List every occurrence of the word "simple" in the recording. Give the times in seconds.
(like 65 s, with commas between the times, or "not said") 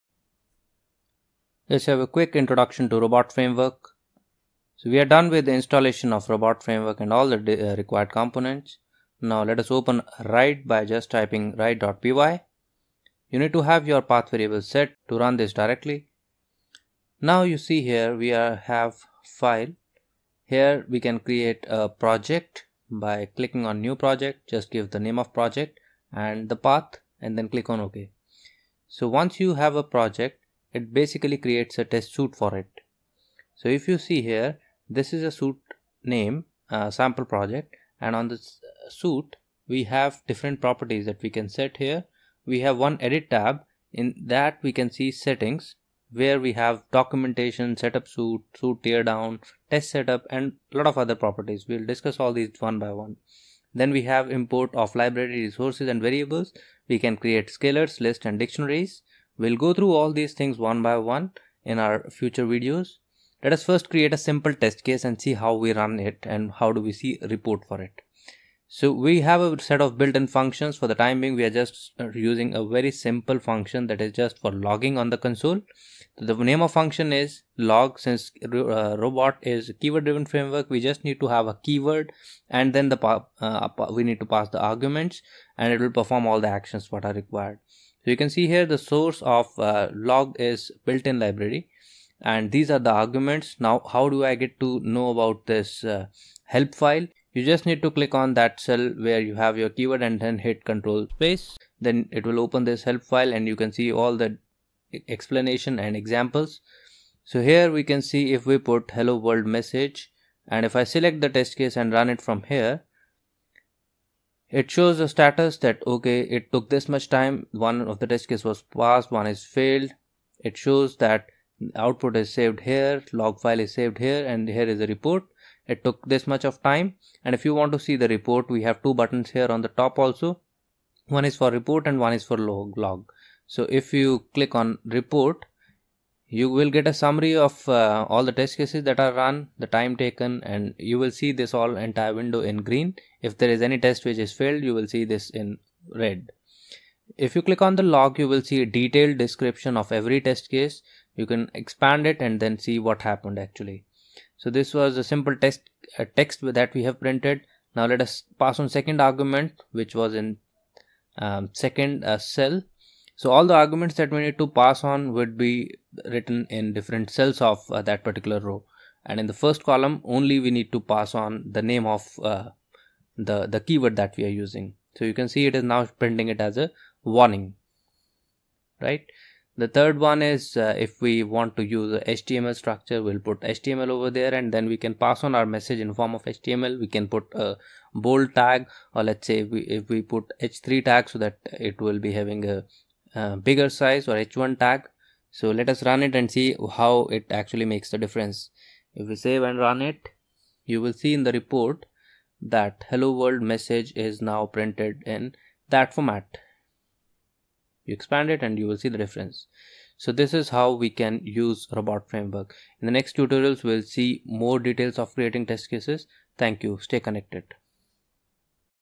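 64 s, 72 s, 155 s.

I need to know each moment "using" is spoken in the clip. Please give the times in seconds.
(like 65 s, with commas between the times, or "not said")
72 s, 174 s.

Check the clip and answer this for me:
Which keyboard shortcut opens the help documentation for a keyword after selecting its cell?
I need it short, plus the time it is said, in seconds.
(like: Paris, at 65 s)
Control Space, at 100 s.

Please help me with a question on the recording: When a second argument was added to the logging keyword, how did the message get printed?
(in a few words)
As a warning.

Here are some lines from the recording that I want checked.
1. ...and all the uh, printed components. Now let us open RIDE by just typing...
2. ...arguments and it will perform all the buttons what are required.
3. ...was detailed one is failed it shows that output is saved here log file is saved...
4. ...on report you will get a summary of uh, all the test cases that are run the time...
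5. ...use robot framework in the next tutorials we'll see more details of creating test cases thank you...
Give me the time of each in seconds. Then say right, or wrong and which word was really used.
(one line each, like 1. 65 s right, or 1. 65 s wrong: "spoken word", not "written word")
1. 6 s wrong: "required", not "printed"
2. 84 s wrong: "actions", not "buttons"
3. 118 s wrong: "passed", not "detailed"
4. 134 s right
5. 211 s right.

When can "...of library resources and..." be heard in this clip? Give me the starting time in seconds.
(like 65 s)
54 s.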